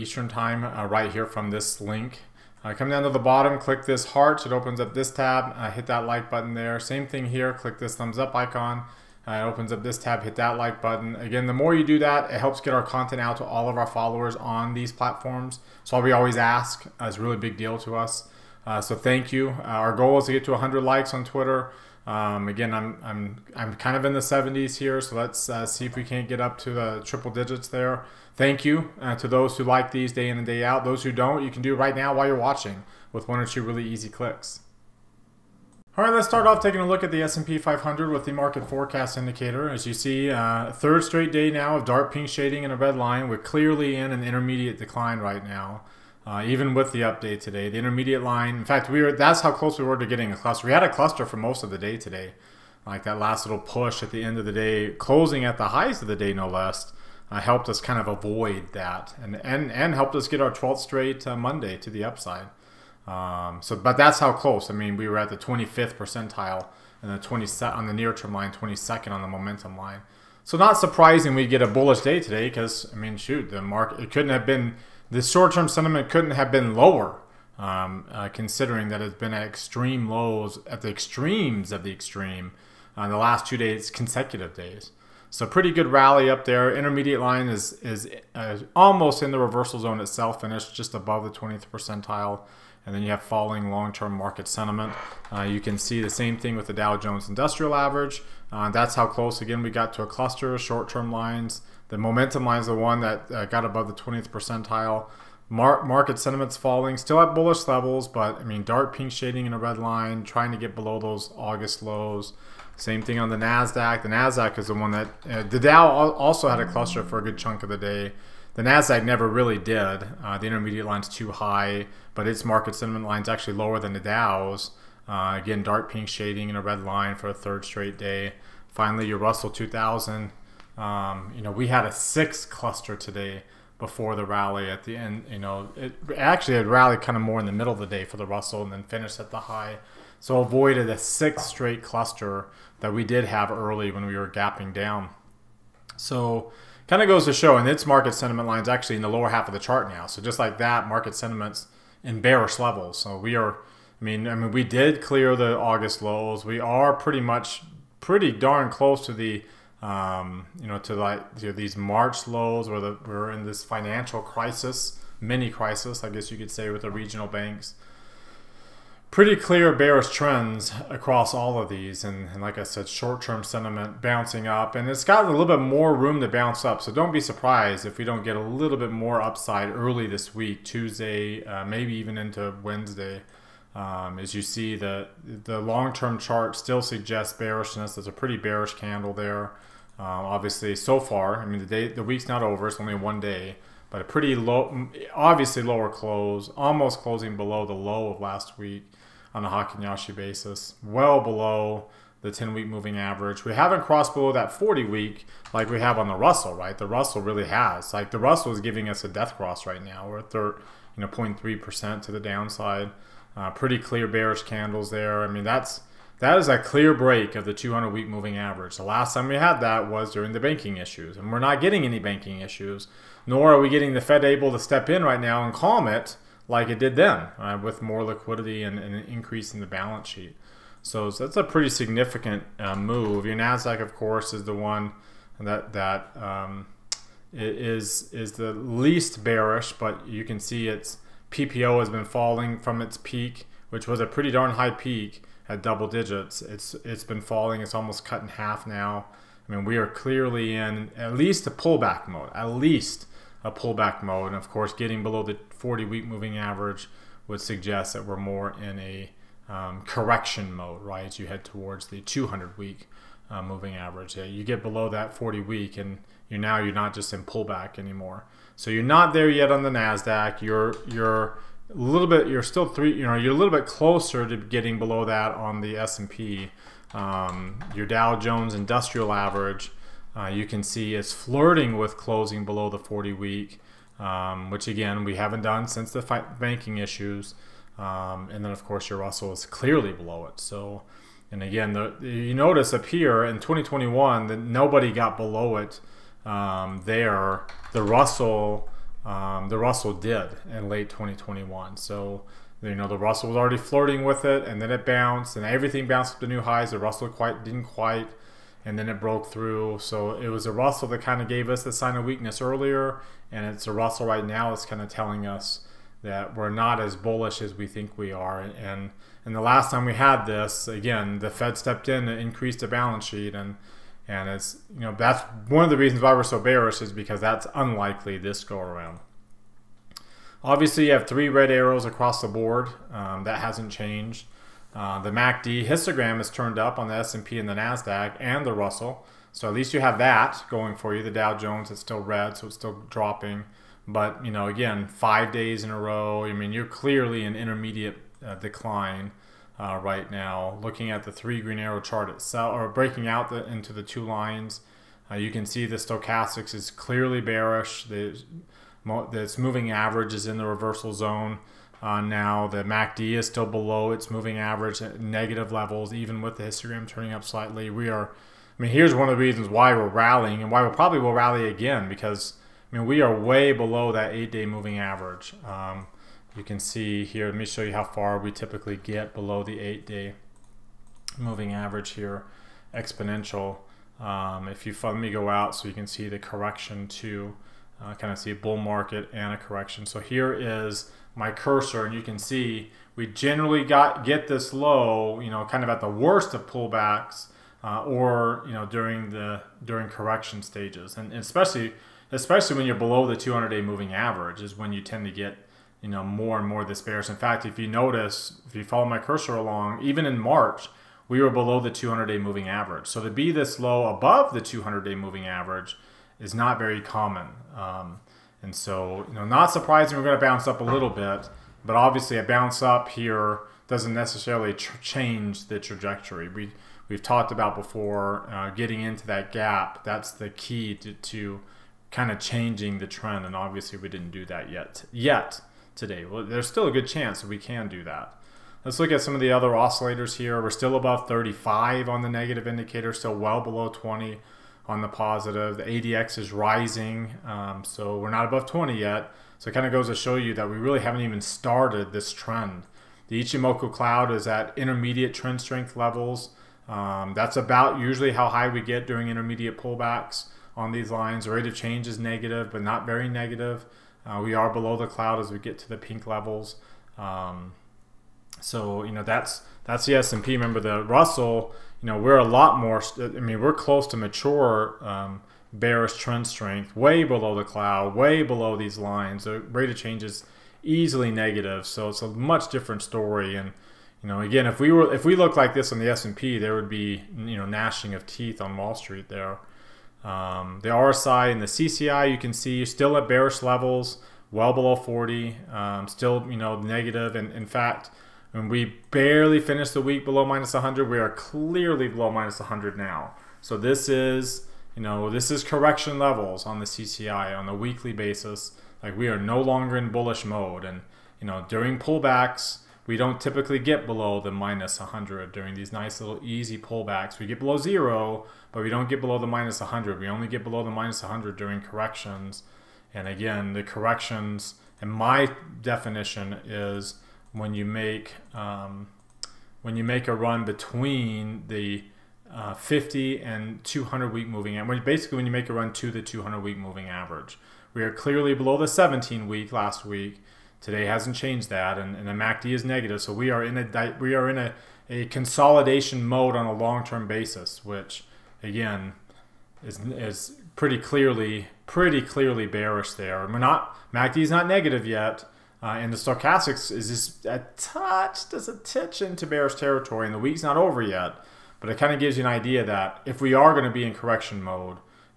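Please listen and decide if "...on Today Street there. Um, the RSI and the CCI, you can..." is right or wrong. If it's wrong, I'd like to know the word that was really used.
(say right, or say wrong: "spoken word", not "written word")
wrong: "Wall", not "Today".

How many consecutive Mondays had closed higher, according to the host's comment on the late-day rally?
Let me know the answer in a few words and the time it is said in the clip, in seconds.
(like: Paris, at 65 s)
12, at 60 s.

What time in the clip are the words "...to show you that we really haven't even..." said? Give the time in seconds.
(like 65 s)
449 s.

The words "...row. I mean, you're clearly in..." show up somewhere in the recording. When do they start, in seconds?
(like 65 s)
345 s.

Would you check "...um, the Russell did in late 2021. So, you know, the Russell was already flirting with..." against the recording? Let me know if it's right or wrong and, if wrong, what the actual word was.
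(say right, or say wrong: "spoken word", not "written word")
right.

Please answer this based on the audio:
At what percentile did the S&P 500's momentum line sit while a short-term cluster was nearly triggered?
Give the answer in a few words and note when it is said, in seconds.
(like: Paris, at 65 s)
22nd, at 68 s.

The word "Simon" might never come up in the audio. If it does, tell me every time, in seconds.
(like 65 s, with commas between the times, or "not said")
not said.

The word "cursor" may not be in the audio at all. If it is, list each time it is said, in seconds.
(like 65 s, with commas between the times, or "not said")
391 s, 408 s.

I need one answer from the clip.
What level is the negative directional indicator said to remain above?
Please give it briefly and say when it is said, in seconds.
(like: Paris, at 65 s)
35, at 440 s.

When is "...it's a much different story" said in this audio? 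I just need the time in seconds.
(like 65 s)
481 s.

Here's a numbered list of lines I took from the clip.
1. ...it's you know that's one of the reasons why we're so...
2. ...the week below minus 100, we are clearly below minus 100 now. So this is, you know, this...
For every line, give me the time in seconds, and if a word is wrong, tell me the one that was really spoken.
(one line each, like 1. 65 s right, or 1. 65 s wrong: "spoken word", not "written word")
1. 324 s right
2. 499 s right.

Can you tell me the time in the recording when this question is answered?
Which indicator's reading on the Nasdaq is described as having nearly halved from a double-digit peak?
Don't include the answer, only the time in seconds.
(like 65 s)
241 s.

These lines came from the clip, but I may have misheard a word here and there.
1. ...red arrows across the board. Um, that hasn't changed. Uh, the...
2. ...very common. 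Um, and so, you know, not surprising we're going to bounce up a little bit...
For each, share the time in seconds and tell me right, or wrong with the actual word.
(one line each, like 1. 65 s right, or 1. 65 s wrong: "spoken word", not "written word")
1. 331 s right
2. 416 s right.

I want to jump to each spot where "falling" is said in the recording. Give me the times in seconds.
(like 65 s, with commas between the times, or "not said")
93 s, 106 s, 242 s, 247 s.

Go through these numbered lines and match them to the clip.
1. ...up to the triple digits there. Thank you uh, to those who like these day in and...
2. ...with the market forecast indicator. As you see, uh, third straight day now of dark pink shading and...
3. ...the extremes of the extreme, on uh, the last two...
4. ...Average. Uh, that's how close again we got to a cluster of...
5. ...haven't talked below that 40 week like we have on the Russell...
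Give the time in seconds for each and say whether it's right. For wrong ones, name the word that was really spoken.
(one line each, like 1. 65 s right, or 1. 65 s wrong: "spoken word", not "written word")
1. 26 s right
2. 38 s right
3. 80 s right
4. 97 s right
5. 203 s wrong: "crossed", not "talked".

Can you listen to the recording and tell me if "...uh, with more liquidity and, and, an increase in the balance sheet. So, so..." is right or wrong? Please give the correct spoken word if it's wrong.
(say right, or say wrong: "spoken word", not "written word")
right.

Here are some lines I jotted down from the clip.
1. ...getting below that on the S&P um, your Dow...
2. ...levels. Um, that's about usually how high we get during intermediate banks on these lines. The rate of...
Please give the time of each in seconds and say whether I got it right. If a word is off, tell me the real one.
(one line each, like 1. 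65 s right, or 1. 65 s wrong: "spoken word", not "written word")
1. 274 s right
2. 455 s wrong: "pullbacks", not "banks".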